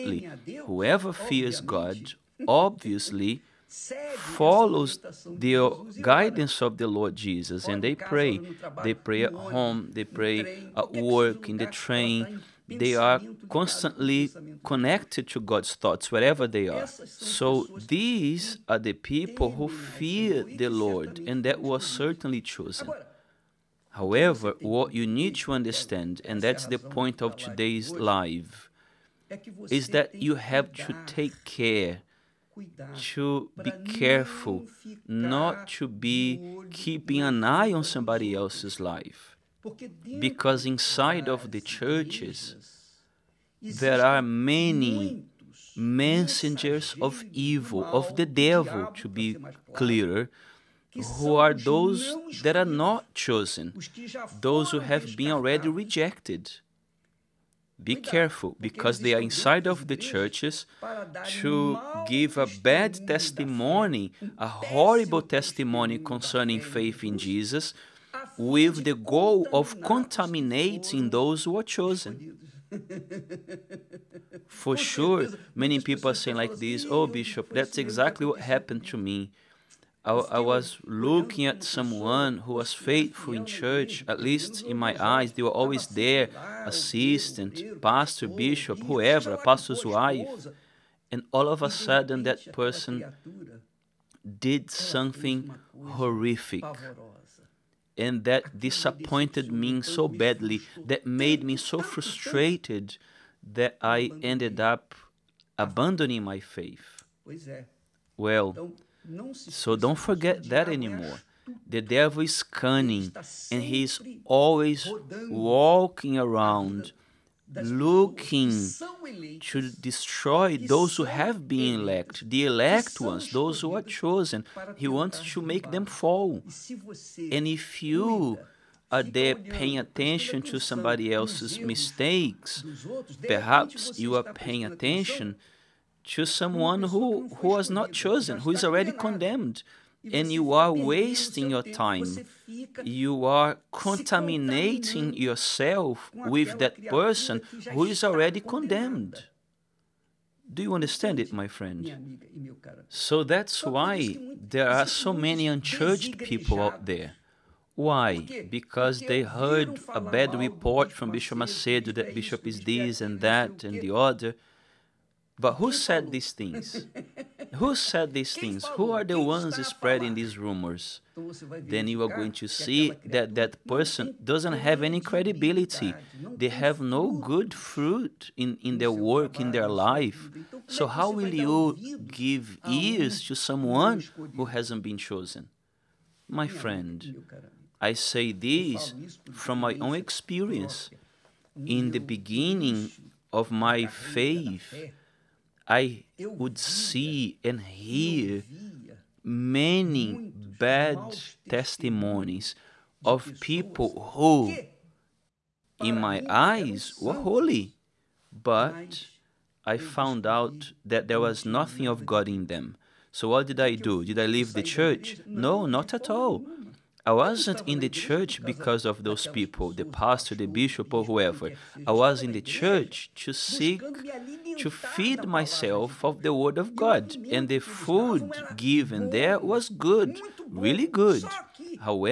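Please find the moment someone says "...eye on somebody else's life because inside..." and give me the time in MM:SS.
00:37.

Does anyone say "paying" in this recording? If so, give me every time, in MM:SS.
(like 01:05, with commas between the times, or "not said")
02:09, 02:14.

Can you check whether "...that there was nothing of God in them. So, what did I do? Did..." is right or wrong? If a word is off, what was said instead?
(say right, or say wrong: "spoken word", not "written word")
right.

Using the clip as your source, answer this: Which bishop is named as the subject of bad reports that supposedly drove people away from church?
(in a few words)
Bishop Macedo.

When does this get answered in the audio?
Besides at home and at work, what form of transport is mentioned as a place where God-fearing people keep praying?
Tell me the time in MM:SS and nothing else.
00:11.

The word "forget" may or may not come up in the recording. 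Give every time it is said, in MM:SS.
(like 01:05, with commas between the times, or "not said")
01:49.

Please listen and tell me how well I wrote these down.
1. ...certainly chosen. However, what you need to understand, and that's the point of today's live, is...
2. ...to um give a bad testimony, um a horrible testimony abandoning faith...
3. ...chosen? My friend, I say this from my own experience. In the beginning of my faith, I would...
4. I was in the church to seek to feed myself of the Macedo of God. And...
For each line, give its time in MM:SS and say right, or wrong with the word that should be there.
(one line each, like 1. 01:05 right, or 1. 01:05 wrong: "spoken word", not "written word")
1. 00:21 right
2. 01:01 wrong: "concerning", not "abandoning"
3. 03:04 right
4. 03:41 wrong: "Word", not "Macedo".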